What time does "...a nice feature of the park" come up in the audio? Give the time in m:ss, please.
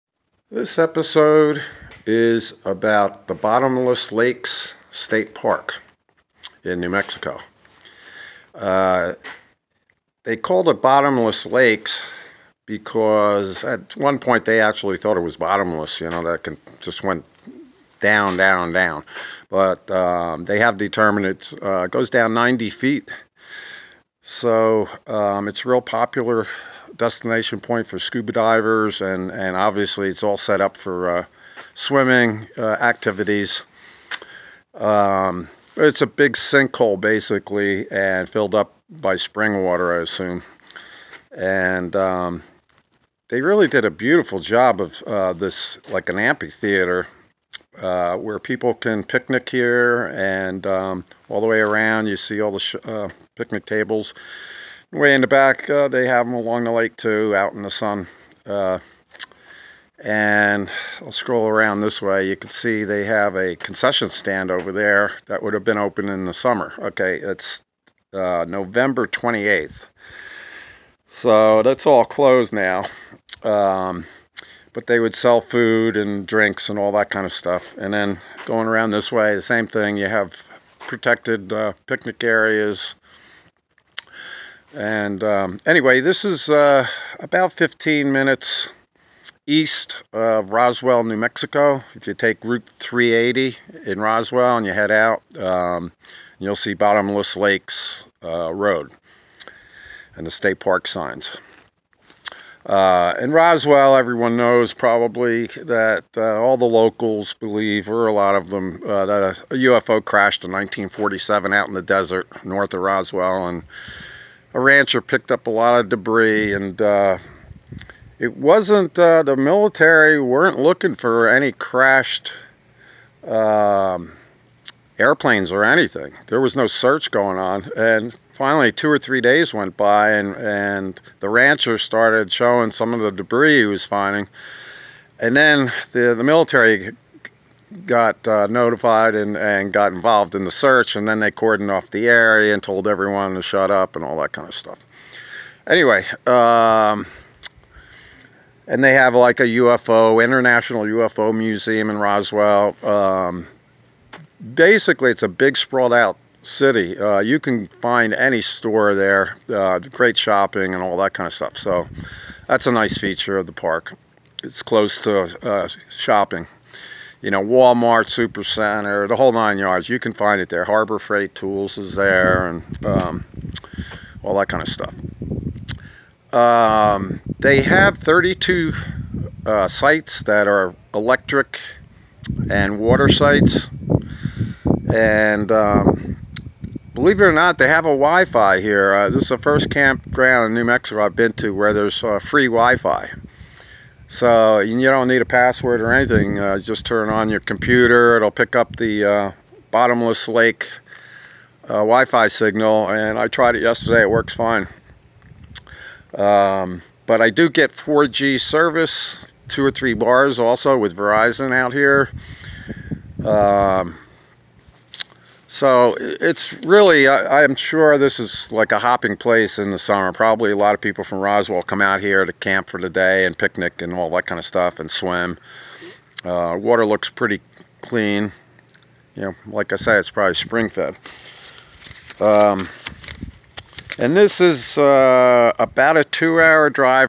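2:42.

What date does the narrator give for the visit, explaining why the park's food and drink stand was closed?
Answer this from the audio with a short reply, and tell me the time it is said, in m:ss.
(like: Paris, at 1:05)
November 28th, at 1:08.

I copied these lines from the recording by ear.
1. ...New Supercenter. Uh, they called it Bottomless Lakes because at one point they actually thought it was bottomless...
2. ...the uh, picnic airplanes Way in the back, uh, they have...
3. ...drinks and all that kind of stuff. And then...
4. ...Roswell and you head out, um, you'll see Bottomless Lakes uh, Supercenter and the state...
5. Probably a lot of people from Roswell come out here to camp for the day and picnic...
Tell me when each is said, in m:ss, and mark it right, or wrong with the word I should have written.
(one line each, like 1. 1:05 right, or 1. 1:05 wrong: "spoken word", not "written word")
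1. 0:06 wrong: "Mexico", not "Supercenter"
2. 0:52 wrong: "tables", not "airplanes"
3. 1:16 right
4. 1:33 wrong: "Road", not "Supercenter"
5. 3:40 right.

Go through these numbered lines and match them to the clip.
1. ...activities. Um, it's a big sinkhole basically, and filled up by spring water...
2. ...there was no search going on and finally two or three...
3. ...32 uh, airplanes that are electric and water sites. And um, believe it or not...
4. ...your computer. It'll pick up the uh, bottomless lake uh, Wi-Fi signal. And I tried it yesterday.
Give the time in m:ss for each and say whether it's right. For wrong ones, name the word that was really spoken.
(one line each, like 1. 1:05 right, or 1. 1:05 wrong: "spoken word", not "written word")
1. 0:32 right
2. 2:06 right
3. 2:57 wrong: "sites", not "airplanes"
4. 3:17 right.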